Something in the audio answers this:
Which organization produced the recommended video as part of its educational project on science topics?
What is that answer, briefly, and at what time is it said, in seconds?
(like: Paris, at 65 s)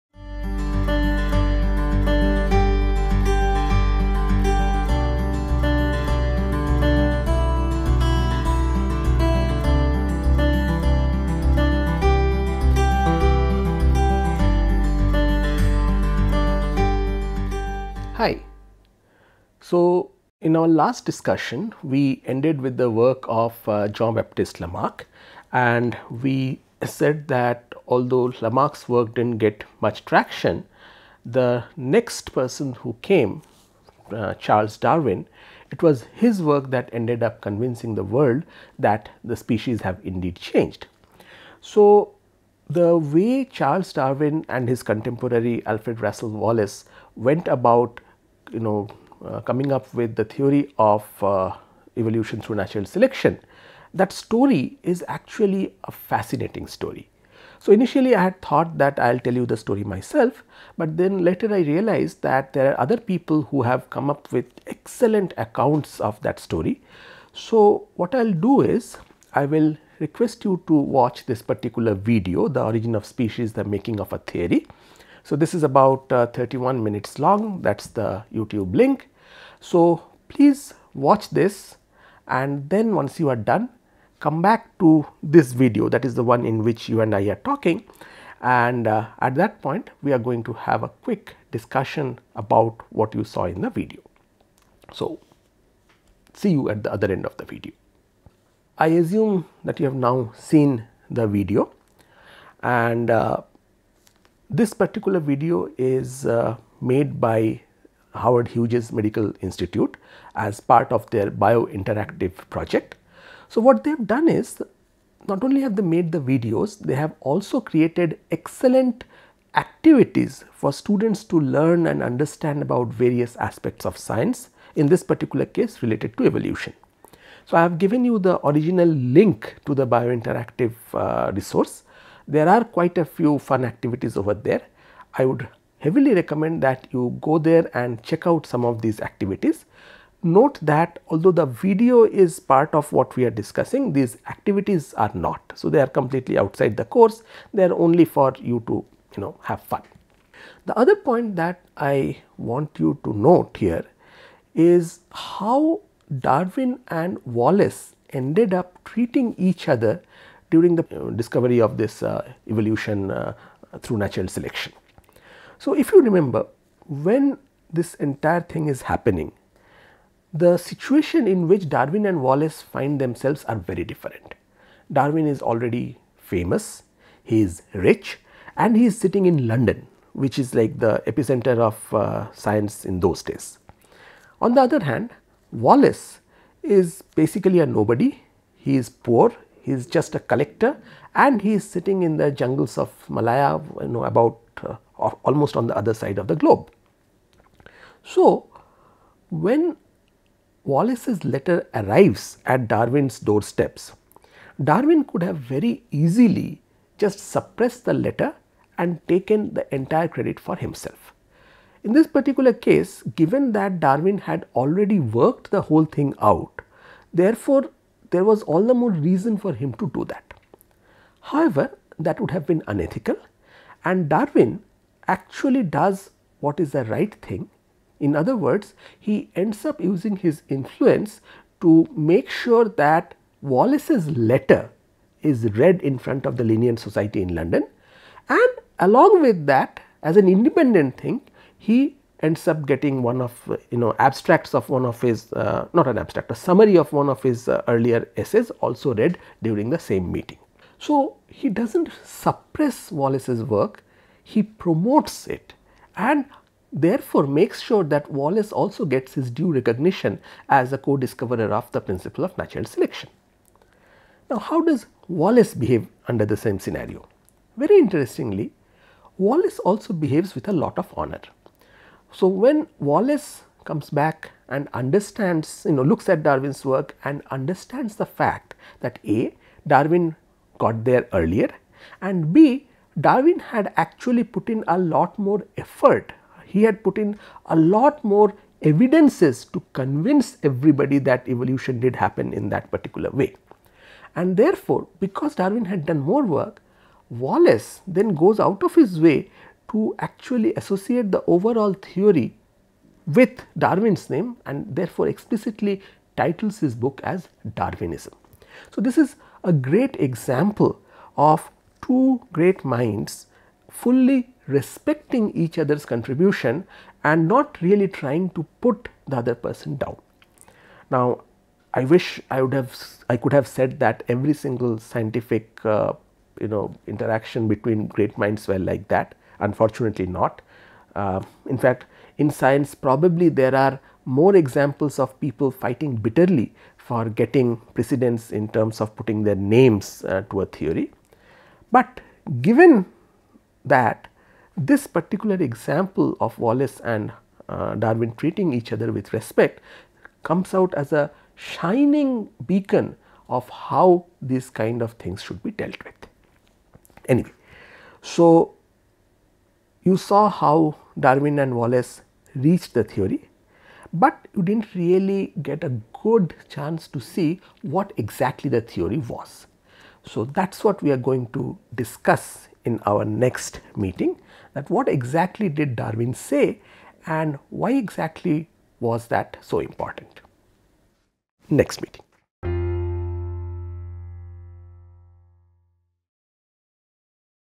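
Howard Hughes Medical Institute, at 108 s.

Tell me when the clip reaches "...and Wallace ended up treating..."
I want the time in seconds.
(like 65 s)
156 s.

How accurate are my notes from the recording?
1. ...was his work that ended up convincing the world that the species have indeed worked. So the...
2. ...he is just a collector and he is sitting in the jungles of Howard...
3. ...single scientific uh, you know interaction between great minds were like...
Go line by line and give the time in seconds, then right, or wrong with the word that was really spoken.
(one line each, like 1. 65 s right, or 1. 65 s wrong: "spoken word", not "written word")
1. 35 s wrong: "changed", not "worked"
2. 189 s wrong: "Malaya", not "Howard"
3. 324 s right.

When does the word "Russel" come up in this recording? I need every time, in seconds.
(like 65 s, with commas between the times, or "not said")
46 s.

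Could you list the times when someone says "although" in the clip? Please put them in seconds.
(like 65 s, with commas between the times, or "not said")
27 s, 141 s.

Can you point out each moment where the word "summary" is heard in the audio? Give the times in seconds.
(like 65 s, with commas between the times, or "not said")
246 s.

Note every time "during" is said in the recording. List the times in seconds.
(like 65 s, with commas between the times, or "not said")
160 s, 249 s.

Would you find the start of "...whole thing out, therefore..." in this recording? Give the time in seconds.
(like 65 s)
215 s.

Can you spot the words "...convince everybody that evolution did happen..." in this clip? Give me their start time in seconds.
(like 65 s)
289 s.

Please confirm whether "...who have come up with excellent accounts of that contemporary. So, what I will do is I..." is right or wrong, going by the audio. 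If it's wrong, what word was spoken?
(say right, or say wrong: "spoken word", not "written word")
wrong: "story", not "contemporary".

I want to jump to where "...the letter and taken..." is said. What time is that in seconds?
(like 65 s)
207 s.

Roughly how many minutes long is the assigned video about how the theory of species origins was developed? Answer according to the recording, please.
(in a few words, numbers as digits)
31.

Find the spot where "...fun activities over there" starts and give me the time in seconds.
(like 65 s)
133 s.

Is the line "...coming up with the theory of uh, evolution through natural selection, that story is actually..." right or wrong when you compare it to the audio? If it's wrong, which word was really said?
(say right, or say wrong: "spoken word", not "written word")
right.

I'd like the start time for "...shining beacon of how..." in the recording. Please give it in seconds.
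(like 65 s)
351 s.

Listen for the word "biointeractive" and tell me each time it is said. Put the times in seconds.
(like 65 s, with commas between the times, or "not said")
111 s, 129 s.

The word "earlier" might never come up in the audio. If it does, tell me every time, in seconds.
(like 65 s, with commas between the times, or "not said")
247 s, 281 s.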